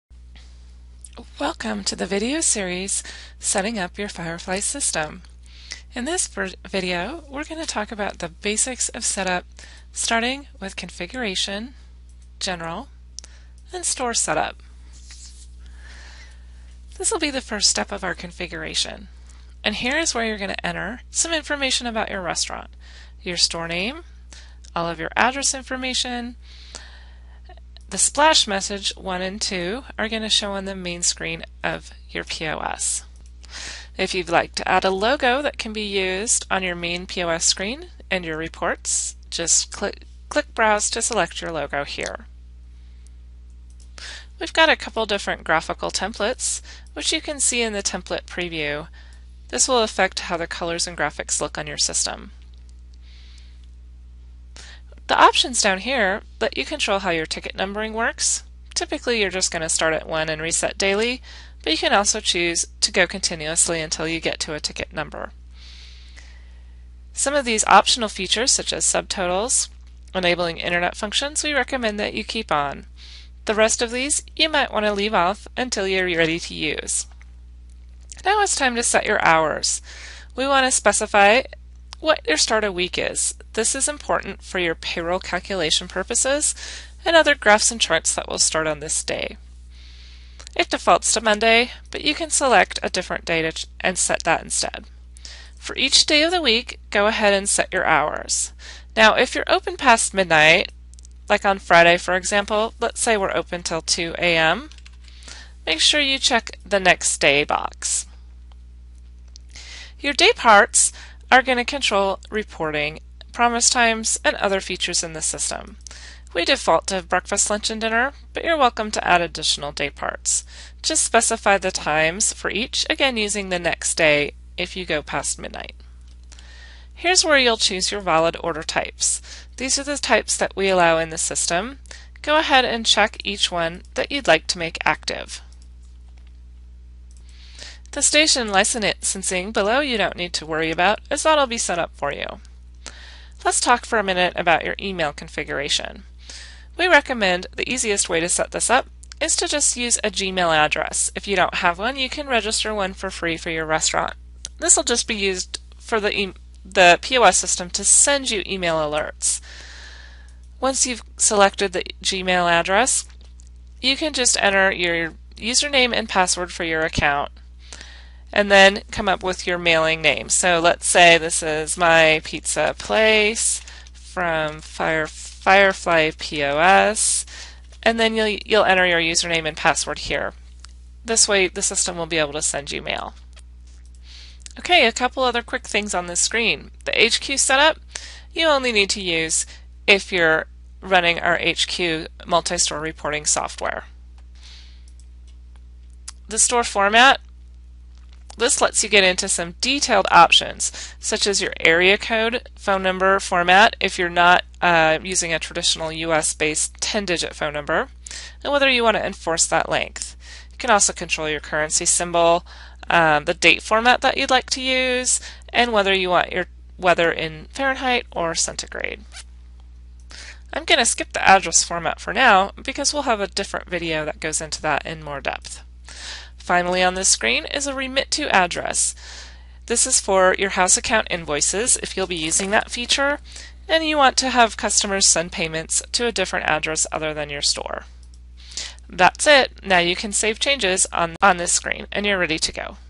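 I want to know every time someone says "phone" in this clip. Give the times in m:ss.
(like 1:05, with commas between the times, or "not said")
3:22, 3:27.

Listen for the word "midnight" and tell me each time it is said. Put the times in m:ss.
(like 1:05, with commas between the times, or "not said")
1:40, 2:05.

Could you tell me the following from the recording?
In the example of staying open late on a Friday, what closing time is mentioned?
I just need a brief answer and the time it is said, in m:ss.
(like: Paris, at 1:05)
2 a.m., at 1:43.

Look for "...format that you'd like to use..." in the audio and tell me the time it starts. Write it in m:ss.
3:33.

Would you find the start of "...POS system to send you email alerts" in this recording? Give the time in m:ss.
2:37.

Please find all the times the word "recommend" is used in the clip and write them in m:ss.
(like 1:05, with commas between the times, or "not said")
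1:11, 2:26.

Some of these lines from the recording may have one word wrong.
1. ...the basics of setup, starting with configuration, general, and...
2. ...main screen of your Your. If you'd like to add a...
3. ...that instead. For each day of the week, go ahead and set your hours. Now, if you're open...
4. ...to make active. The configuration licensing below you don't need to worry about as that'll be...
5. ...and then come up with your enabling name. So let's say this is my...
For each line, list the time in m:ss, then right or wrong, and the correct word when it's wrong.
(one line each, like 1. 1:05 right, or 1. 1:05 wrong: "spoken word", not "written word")
1. 0:08 right
2. 0:30 wrong: "POS", not "Your"
3. 1:34 right
4. 2:14 wrong: "station", not "configuration"
5. 2:48 wrong: "mailing", not "enabling".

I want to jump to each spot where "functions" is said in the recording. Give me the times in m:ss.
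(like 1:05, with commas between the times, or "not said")
1:10.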